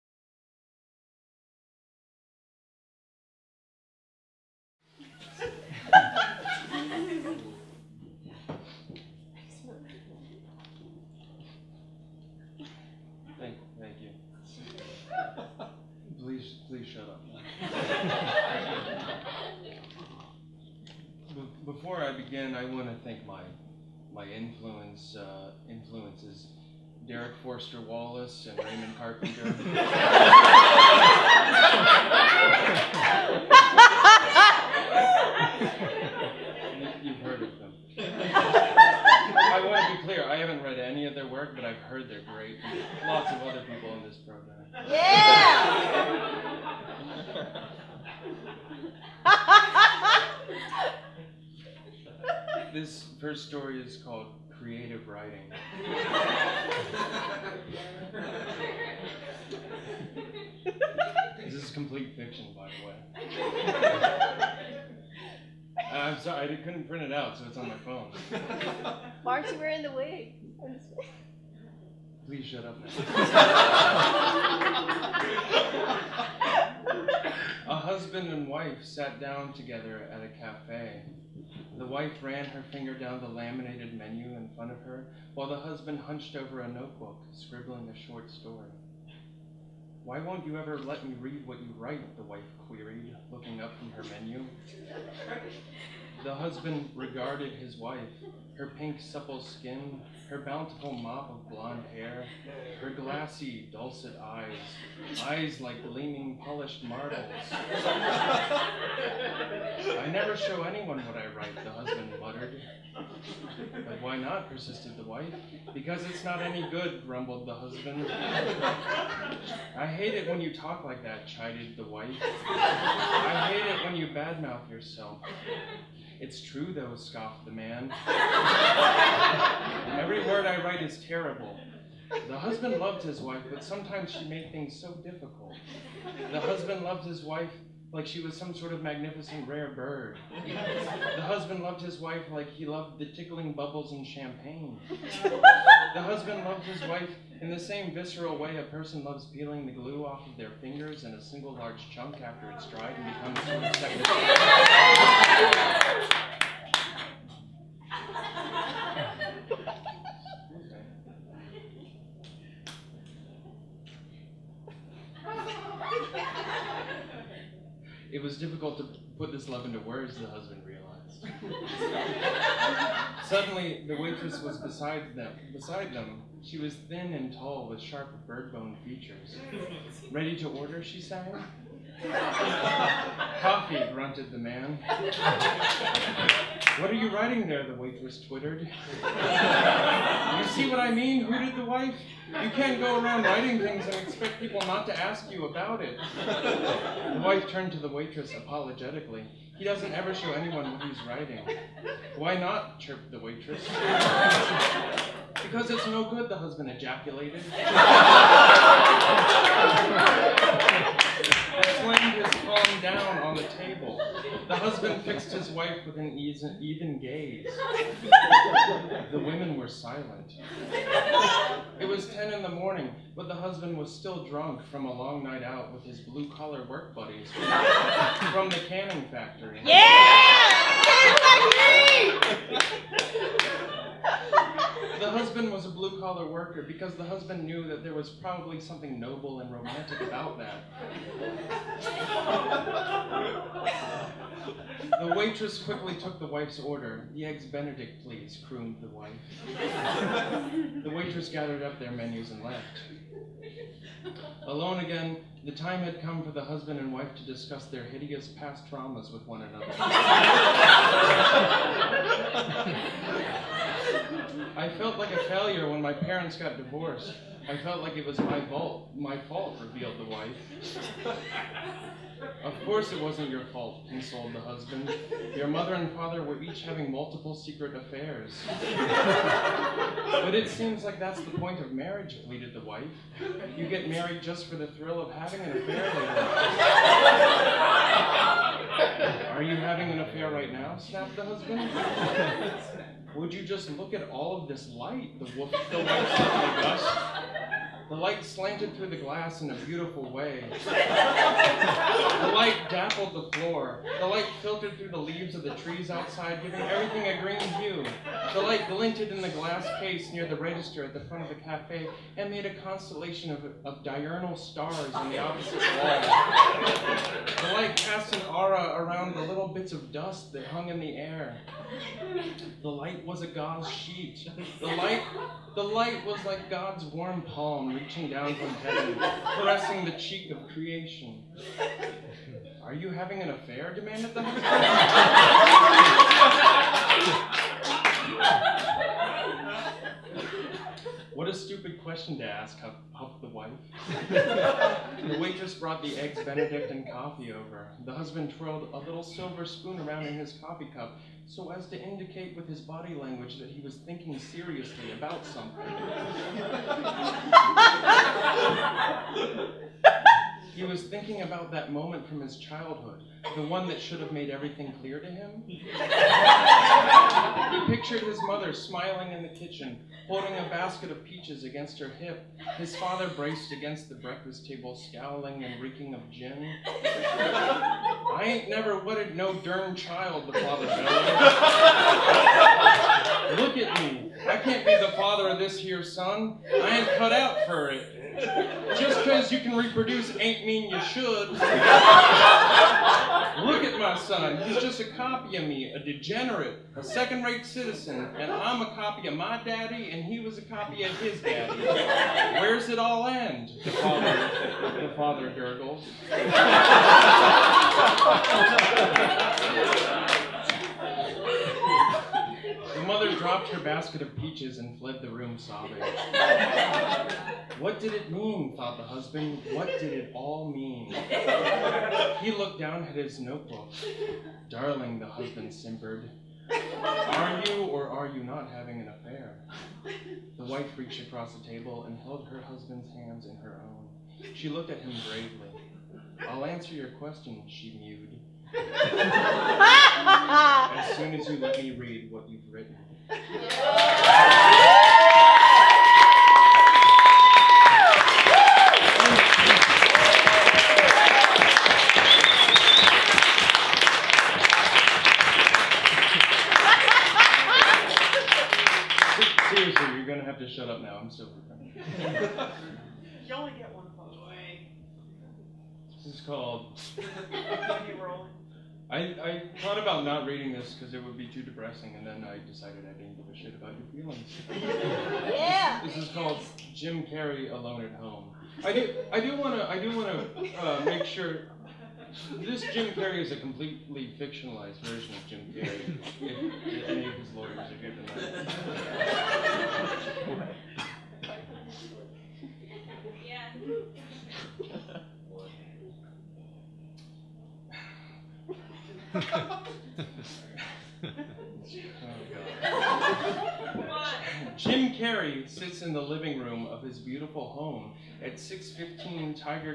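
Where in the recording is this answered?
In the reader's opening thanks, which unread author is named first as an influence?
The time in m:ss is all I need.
0:27.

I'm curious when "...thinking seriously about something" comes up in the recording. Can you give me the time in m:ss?
5:53.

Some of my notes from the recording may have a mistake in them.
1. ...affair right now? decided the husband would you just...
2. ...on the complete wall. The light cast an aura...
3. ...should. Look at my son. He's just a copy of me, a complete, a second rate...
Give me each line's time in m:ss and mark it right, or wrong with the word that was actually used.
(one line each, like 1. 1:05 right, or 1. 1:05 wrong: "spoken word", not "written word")
1. 4:49 wrong: "snapped", not "decided"
2. 5:14 wrong: "opposite", not "complete"
3. 6:30 wrong: "degenerate", not "complete".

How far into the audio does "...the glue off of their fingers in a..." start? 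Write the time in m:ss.
2:29.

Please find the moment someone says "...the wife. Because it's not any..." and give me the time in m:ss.
1:54.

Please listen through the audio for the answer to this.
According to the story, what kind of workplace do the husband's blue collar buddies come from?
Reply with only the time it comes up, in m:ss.
3:48.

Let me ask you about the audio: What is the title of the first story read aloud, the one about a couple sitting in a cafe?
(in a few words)
Creative Writing.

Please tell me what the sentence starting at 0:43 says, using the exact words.
Lots of other people in this program.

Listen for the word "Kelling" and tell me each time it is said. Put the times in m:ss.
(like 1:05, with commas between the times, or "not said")
not said.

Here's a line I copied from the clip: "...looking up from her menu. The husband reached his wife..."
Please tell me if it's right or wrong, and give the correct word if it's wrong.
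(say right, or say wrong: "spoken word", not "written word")
wrong: "regarded", not "reached".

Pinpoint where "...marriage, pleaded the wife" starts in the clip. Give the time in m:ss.
4:41.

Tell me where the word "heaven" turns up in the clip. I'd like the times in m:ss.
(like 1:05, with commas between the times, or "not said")
5:28.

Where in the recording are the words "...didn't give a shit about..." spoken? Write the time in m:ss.
7:52.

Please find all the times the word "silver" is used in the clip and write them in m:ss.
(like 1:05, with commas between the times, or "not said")
5:49.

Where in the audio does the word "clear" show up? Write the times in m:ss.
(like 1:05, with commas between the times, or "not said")
0:40, 6:04.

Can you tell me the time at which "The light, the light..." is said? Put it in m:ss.
5:24.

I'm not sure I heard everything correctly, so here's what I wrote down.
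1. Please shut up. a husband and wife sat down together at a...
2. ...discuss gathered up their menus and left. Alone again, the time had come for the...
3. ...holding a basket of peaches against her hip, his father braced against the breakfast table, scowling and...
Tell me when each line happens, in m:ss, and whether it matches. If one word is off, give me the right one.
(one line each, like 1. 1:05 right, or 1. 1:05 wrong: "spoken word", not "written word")
1. 1:12 right
2. 4:10 wrong: "waitress", not "discuss"
3. 6:10 right.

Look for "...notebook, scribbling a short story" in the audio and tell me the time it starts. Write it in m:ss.
1:26.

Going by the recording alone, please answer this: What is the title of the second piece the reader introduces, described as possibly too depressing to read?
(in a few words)
Jim Carrey Alone at Home.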